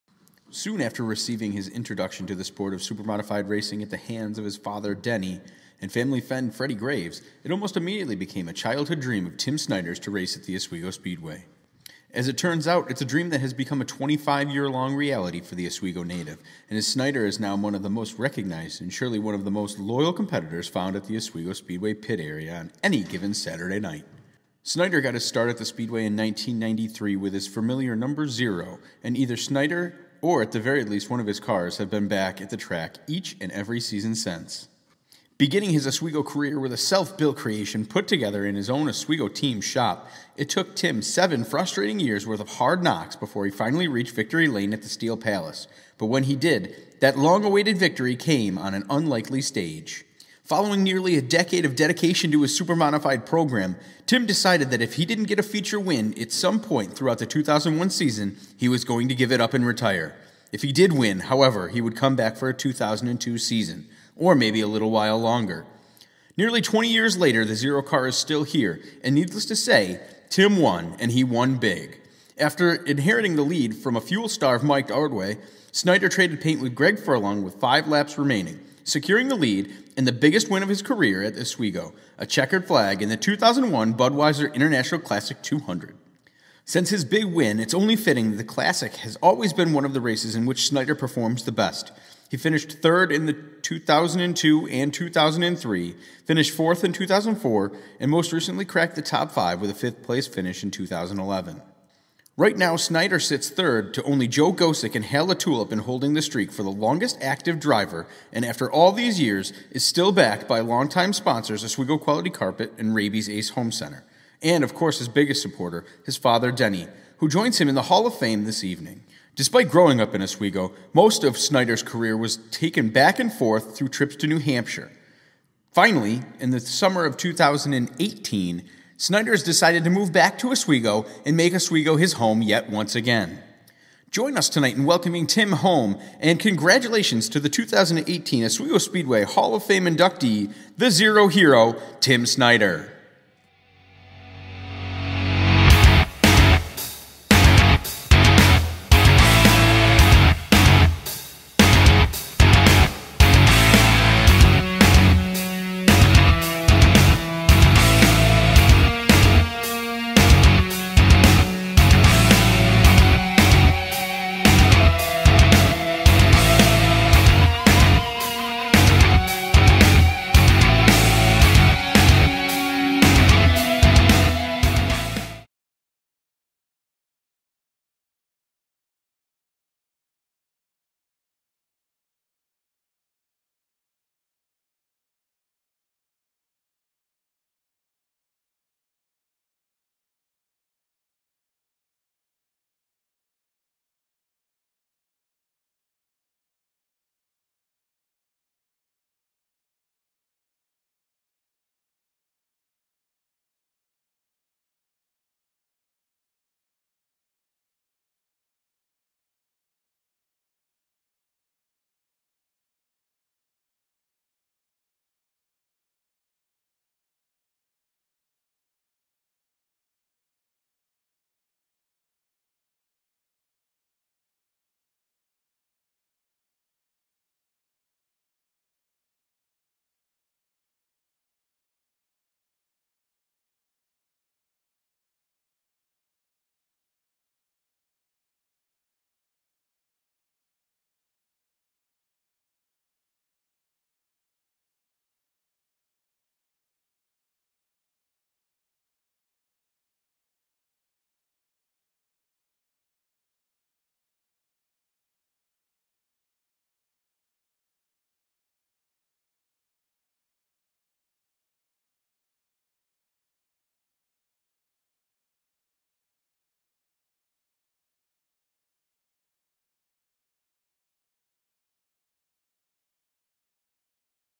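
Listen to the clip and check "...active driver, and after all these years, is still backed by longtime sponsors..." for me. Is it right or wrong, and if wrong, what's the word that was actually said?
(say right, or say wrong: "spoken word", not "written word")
right.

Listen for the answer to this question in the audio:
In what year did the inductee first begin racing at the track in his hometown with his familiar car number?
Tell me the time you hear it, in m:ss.
0:26.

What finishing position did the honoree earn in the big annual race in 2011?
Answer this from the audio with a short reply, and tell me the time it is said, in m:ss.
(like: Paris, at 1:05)
Fifth, at 1:39.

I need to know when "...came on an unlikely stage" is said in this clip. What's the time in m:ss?
0:48.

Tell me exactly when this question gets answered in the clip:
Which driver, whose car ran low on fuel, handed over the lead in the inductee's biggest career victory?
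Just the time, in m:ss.
1:14.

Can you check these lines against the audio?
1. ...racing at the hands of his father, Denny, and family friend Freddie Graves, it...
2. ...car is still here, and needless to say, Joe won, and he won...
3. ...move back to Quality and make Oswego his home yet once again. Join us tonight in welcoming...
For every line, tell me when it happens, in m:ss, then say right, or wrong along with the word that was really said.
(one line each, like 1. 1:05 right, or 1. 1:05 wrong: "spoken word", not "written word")
1. 0:03 right
2. 1:07 wrong: "Tim", not "Joe"
3. 2:09 wrong: "Oswego", not "Quality".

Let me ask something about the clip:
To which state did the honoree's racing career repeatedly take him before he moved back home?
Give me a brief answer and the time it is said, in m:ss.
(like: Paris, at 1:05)
New Hampshire, at 2:04.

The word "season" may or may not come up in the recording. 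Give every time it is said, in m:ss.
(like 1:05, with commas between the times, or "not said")
0:33, 0:57, 1:03.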